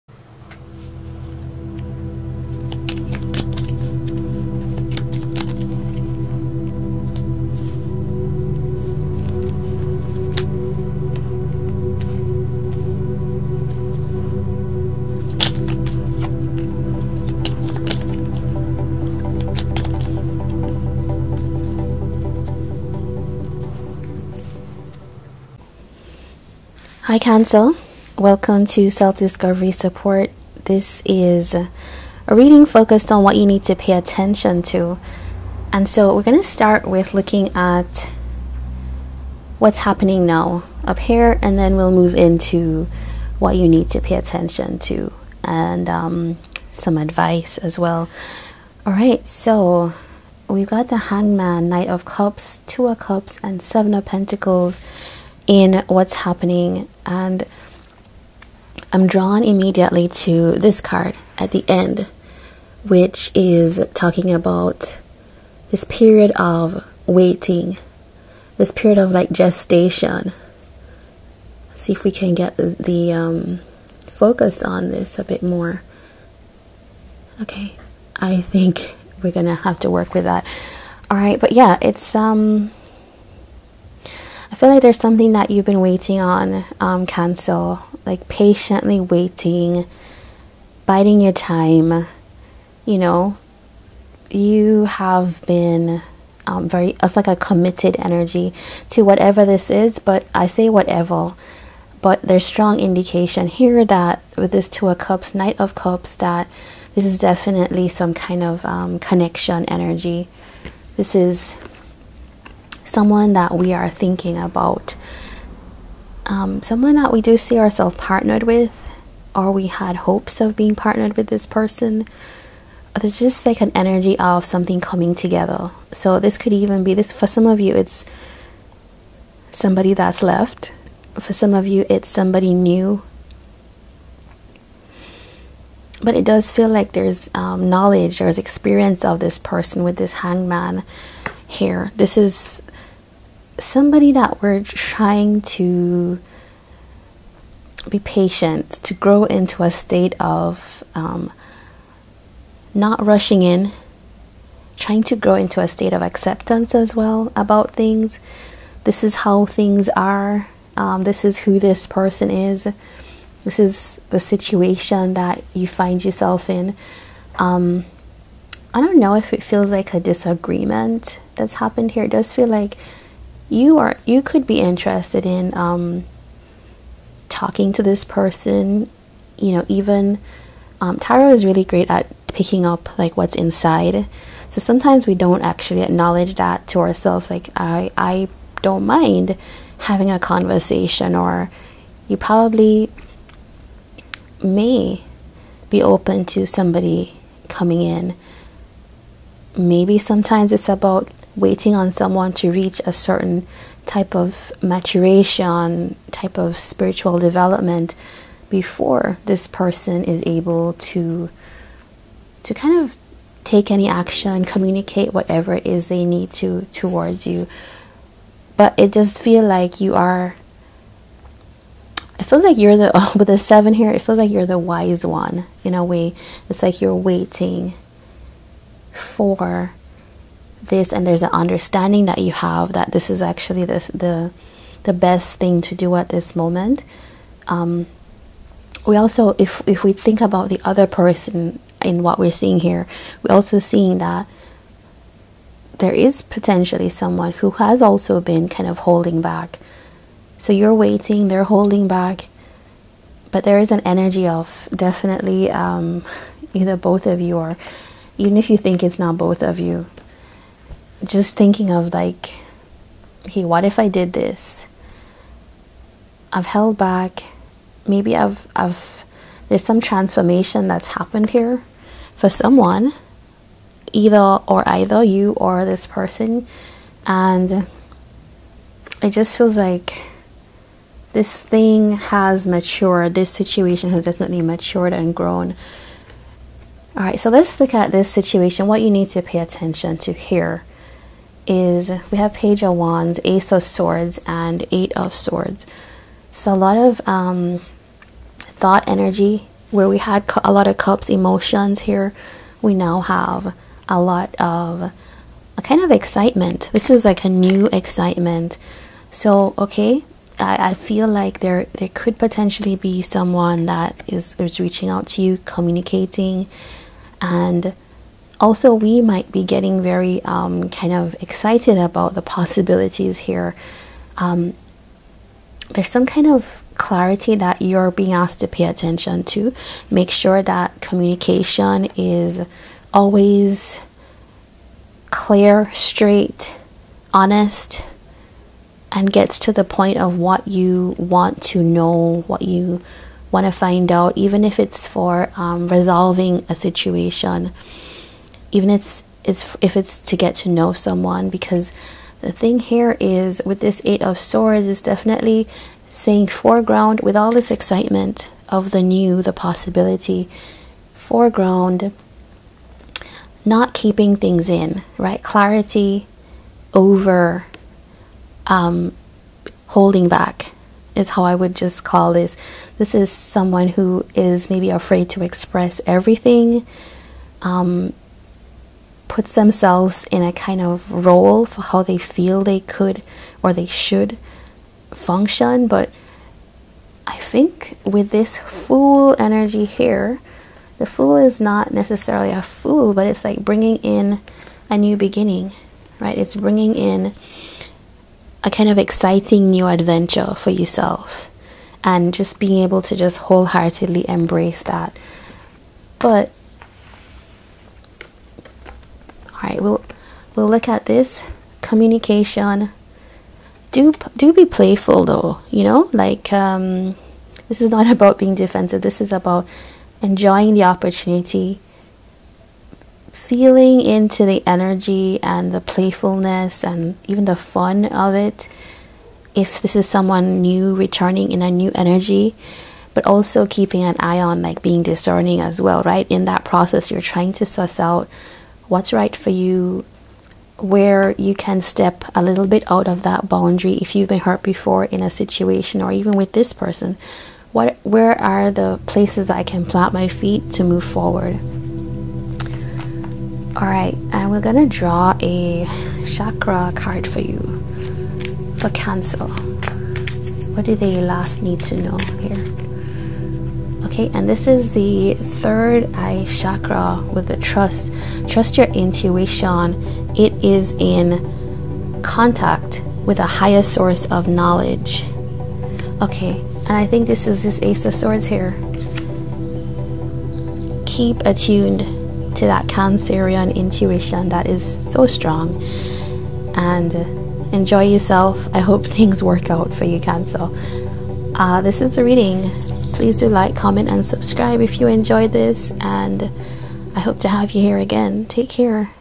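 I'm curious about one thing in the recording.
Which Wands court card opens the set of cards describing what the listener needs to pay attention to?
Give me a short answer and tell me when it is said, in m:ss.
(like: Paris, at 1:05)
Page of Wands, at 4:52.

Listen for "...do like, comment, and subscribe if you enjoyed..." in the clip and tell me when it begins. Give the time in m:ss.
8:13.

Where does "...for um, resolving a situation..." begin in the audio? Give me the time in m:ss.
5:44.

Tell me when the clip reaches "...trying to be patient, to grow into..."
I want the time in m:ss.
2:24.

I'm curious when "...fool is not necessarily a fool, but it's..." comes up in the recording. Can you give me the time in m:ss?
6:30.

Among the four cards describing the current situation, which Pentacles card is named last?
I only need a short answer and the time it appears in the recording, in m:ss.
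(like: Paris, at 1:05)
Seven of Pentacles, at 0:53.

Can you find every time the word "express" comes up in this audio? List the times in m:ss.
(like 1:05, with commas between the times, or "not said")
6:15.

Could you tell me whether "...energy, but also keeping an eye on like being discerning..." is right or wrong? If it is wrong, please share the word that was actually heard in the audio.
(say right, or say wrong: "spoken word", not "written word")
right.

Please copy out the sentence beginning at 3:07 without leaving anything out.
Like I, I don't mind having a conversation, or you probably may be open to somebody coming in.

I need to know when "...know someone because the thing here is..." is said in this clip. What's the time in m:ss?
5:50.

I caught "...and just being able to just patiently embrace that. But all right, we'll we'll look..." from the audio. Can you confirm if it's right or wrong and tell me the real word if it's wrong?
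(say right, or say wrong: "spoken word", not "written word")
wrong: "wholeheartedly", not "patiently".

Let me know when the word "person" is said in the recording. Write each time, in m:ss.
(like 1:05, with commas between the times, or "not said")
2:01, 2:19, 2:41, 2:58, 3:29, 4:00, 4:35, 7:26.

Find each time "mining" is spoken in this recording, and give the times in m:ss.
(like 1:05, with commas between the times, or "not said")
not said.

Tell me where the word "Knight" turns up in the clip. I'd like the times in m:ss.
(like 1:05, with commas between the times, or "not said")
0:51, 1:45.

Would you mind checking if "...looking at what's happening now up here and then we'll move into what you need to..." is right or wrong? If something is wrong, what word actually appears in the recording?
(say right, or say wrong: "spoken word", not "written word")
right.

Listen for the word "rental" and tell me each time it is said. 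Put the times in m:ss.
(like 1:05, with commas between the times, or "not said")
not said.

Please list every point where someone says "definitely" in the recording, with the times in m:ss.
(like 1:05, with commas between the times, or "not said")
1:47, 4:14, 4:44, 5:54.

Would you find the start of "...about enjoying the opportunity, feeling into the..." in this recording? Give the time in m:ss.
6:59.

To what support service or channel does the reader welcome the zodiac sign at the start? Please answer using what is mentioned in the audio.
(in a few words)
Self-Discovery Support.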